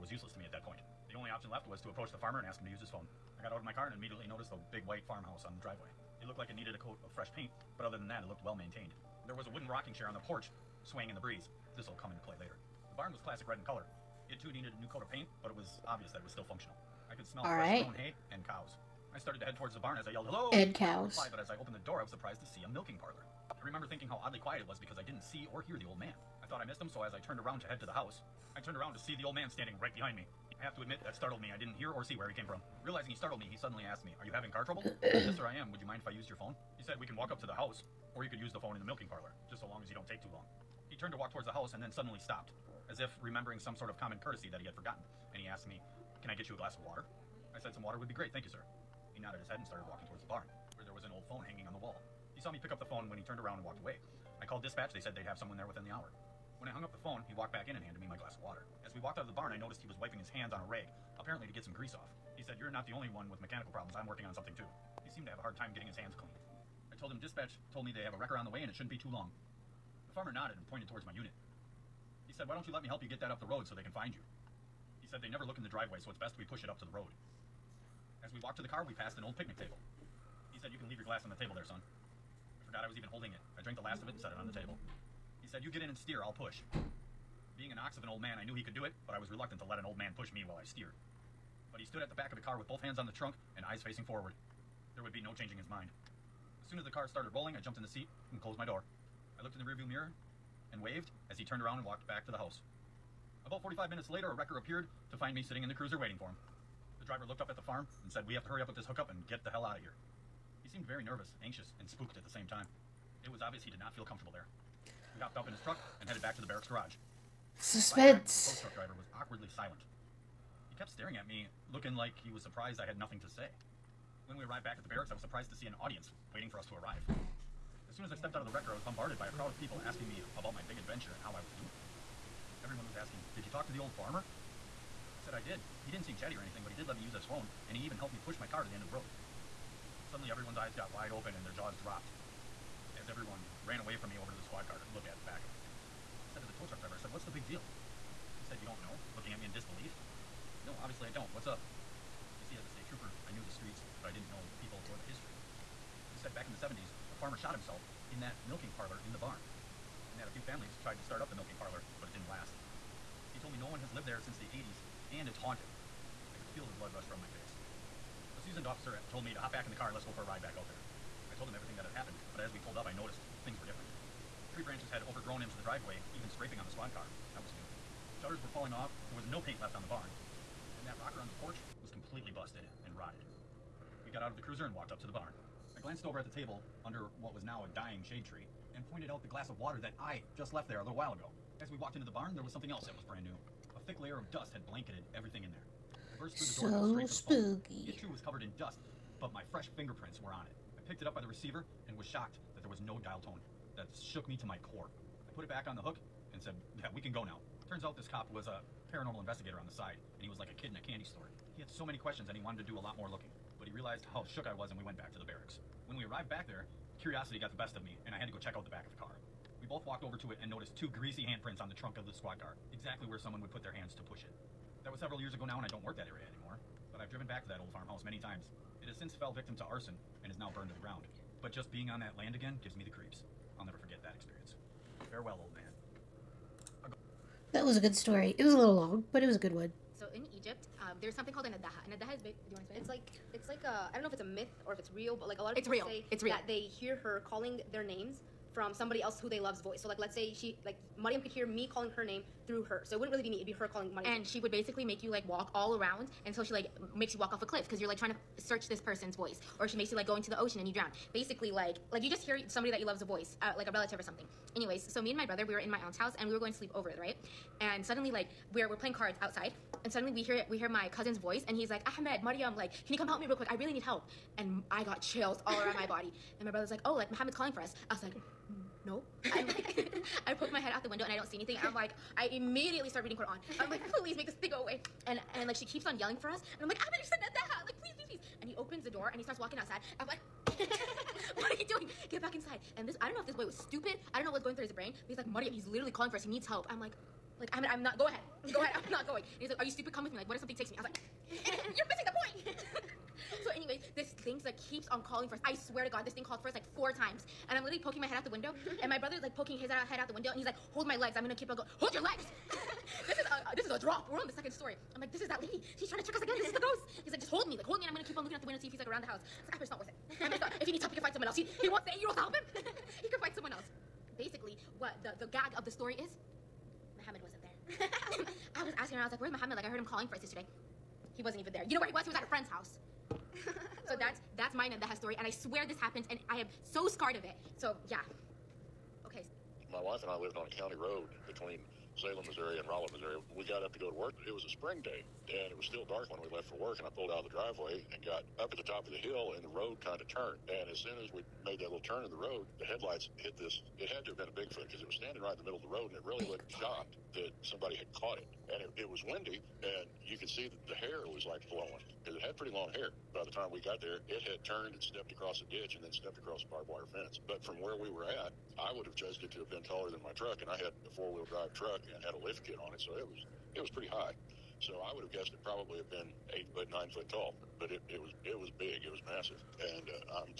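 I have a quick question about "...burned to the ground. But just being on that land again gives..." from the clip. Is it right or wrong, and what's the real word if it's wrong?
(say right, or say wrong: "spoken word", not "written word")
right.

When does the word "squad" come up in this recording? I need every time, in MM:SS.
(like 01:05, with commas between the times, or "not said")
02:24, 02:56, 03:42.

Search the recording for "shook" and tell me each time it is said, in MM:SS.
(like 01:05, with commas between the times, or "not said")
03:24, 03:34.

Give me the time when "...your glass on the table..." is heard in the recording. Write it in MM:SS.
01:20.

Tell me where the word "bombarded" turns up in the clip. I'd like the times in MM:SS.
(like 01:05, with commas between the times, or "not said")
02:08.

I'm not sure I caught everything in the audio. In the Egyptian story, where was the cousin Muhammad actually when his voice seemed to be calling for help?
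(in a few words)
At a friend's house.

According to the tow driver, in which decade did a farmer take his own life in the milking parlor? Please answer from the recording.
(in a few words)
the 70s.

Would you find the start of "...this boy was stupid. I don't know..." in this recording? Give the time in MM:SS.
04:53.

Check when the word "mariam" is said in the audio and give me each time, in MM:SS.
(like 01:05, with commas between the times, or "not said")
04:10, 04:32.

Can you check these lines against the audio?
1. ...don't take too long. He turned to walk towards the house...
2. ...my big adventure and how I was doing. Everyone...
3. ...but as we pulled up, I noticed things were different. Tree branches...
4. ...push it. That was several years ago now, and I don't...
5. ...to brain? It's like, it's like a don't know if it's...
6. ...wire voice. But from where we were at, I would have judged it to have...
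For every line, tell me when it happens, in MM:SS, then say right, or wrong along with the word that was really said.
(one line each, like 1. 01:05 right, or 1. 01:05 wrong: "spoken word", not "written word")
1. 00:39 right
2. 02:10 right
3. 02:52 right
4. 03:44 right
5. 04:02 wrong: "explain", not "brain"
6. 06:06 wrong: "fence", not "voice".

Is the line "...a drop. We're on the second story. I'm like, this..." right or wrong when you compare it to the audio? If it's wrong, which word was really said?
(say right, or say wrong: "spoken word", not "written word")
right.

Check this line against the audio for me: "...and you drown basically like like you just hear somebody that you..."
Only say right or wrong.
right.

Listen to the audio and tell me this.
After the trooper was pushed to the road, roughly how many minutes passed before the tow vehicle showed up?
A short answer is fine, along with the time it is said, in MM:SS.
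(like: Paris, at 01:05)
45, at 01:43.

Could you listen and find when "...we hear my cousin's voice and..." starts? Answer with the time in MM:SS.
04:30.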